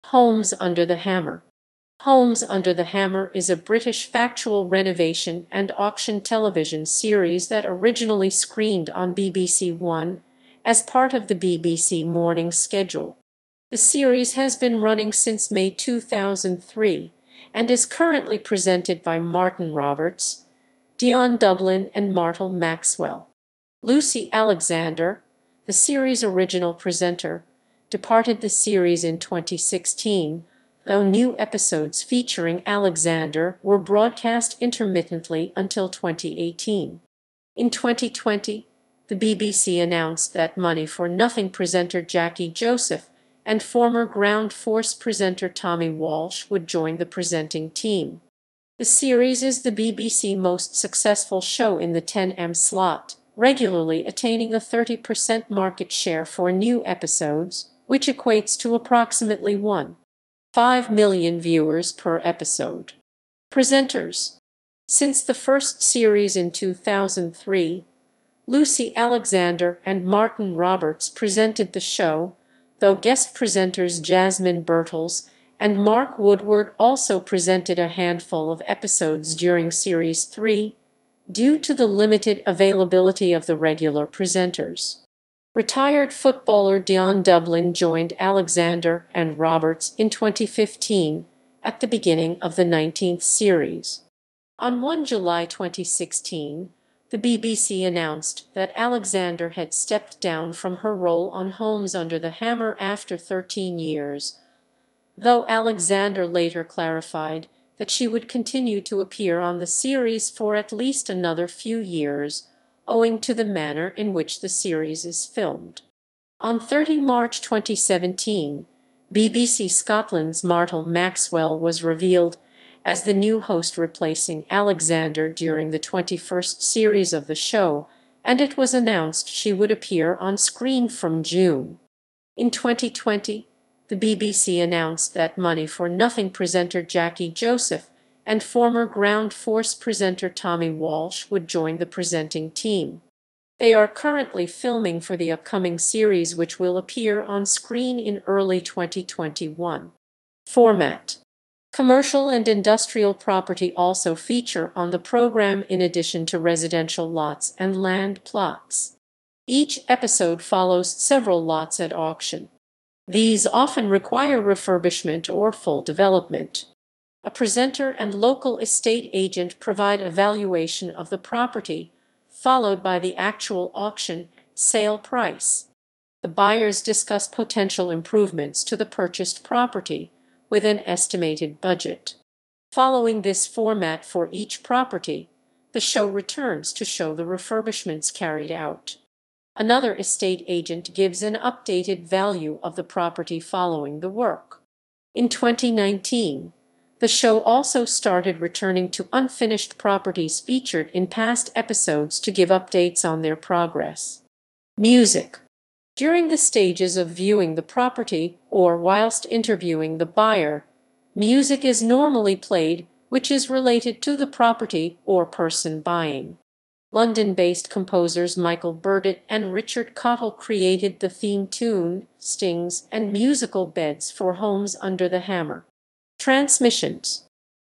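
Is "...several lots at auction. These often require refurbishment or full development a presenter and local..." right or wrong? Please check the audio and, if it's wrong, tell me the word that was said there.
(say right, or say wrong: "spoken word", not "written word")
right.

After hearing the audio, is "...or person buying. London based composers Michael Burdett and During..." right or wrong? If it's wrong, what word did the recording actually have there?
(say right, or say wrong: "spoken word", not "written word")
wrong: "Richard", not "During".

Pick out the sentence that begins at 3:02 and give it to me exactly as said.
Following this format for each property, the show returns to show the refurbishments carried out.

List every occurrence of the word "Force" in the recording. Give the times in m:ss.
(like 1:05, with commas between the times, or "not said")
0:44, 2:19.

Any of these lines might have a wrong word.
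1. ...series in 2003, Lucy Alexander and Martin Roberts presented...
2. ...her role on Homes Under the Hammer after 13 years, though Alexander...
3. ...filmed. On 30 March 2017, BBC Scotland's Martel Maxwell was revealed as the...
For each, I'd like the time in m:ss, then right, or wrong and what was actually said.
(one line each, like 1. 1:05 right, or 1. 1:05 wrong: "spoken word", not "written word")
1. 1:05 right
2. 1:40 right
3. 1:55 right.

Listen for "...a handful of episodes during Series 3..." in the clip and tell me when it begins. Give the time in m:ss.
1:17.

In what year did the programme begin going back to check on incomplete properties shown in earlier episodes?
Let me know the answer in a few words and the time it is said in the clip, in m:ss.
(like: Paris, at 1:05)
2019, at 3:15.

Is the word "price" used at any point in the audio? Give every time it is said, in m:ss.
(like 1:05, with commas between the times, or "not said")
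2:54.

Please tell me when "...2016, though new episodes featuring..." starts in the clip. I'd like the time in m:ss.
0:29.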